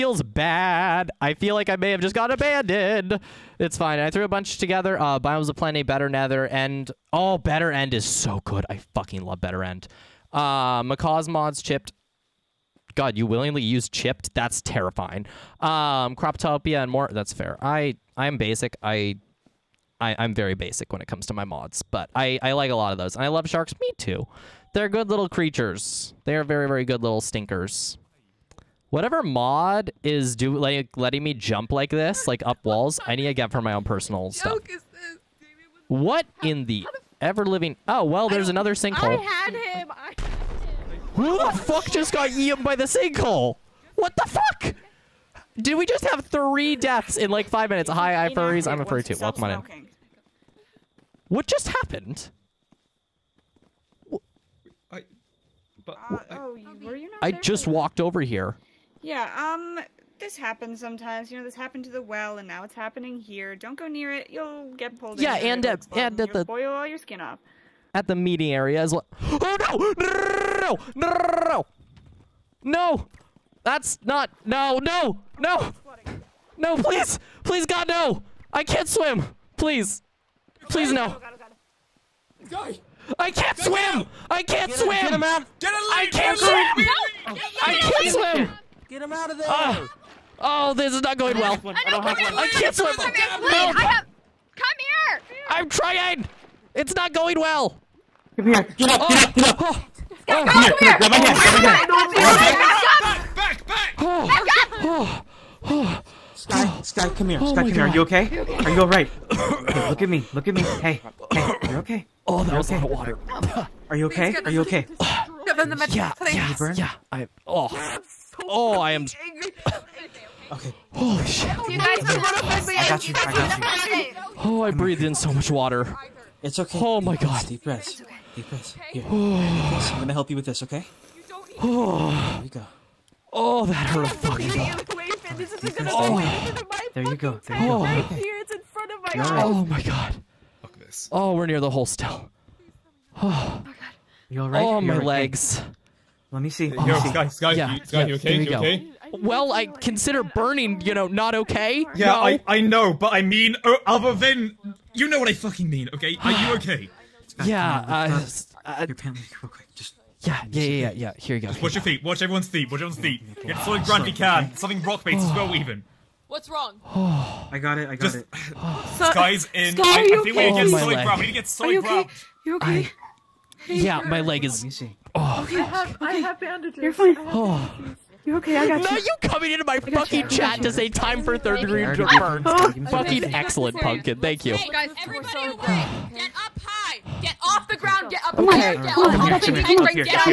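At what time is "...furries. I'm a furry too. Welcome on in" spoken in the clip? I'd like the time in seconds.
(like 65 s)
48 s.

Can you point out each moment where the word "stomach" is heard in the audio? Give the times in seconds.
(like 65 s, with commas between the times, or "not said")
not said.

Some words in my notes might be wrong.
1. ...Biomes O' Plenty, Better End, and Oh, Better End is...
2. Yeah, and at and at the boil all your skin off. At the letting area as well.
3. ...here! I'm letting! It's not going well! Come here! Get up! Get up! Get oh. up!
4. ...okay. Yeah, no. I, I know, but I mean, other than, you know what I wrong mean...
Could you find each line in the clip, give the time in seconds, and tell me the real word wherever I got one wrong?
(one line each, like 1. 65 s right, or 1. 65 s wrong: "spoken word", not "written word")
1. 5 s wrong: "Nether", not "End"
2. 65 s wrong: "meeting", not "letting"
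3. 94 s wrong: "trying", not "letting"
4. 151 s wrong: "fucking", not "wrong".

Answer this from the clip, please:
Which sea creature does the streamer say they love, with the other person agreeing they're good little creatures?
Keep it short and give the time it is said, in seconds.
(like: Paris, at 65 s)
sharks, at 23 s.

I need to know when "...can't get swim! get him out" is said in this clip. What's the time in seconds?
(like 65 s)
84 s.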